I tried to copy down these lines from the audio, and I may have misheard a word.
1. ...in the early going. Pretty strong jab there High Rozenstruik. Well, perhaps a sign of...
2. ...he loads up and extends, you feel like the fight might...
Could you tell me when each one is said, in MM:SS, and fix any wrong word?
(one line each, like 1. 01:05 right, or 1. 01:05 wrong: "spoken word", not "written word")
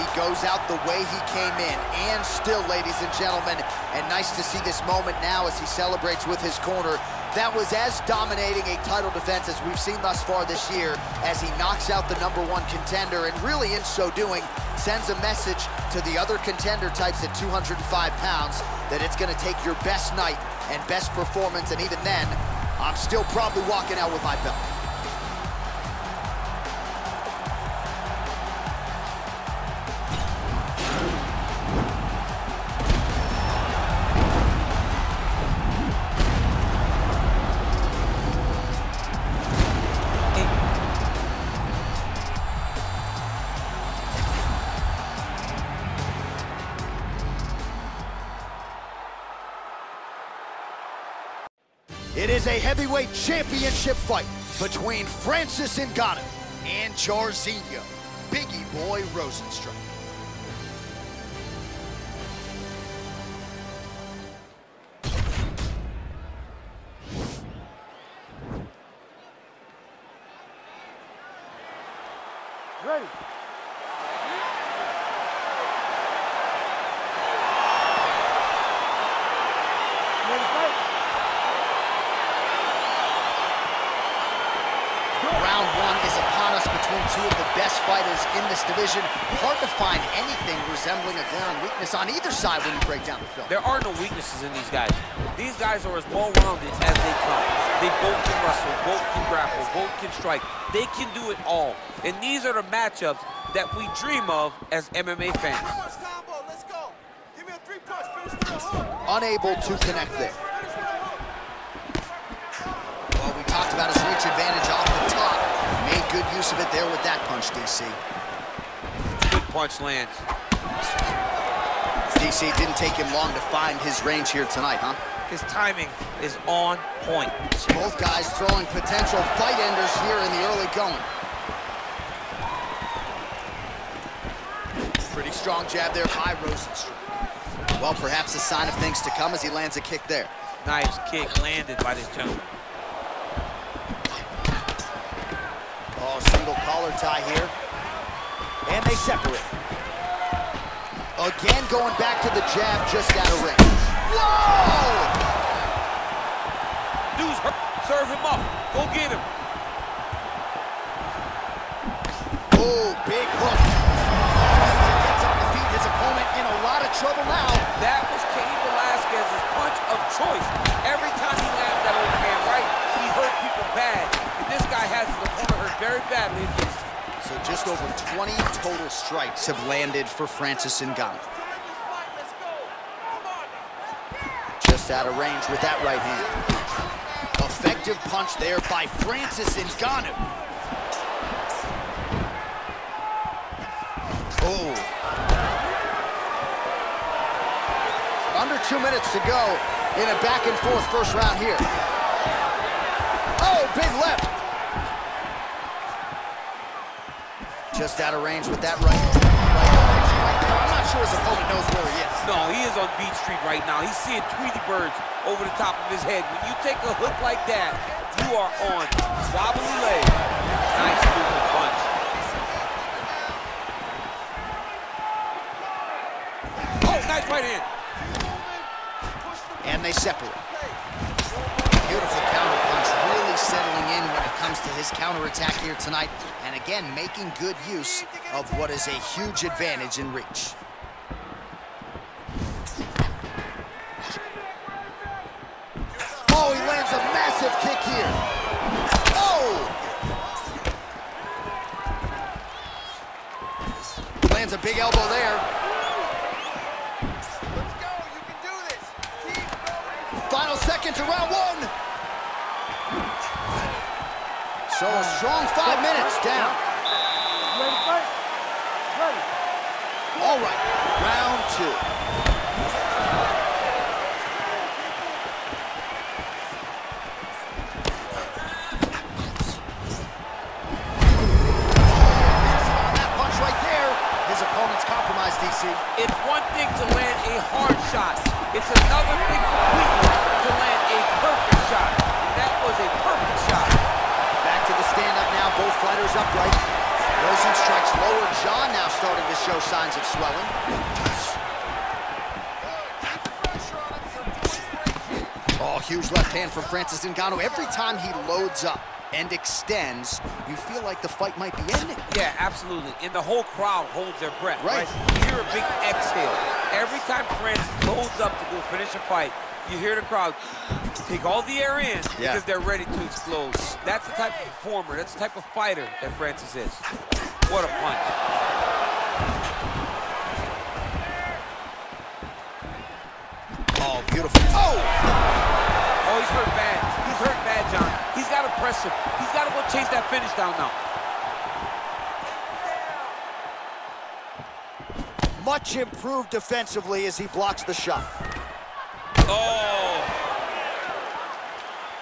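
1. 02:10 right
2. 05:07 right.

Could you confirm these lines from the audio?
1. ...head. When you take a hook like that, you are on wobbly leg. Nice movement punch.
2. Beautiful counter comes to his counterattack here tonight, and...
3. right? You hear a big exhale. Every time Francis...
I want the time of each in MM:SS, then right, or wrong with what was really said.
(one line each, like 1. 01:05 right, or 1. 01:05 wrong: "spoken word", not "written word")
1. 03:36 right
2. 03:51 right
3. 05:14 right.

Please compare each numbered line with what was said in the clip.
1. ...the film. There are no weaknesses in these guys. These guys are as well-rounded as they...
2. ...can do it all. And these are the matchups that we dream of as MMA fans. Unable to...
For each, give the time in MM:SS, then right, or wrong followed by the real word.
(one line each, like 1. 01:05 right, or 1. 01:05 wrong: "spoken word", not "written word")
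1. 01:33 right
2. 01:40 right.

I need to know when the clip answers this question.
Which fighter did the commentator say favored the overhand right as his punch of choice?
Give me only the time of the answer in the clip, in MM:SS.
02:48.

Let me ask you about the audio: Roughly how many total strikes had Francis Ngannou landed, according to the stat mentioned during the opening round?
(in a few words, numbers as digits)
Just over 20.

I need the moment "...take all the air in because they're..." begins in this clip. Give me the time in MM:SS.
05:21.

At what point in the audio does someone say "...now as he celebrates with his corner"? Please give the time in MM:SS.
00:05.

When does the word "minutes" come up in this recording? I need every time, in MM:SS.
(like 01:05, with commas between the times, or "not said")
03:18, 04:25.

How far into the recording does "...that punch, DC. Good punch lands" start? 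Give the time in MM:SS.
01:57.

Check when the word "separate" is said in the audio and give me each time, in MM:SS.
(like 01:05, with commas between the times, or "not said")
02:28, 03:49.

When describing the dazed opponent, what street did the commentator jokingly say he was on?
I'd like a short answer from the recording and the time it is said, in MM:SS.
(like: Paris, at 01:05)
Beach Street, at 03:32.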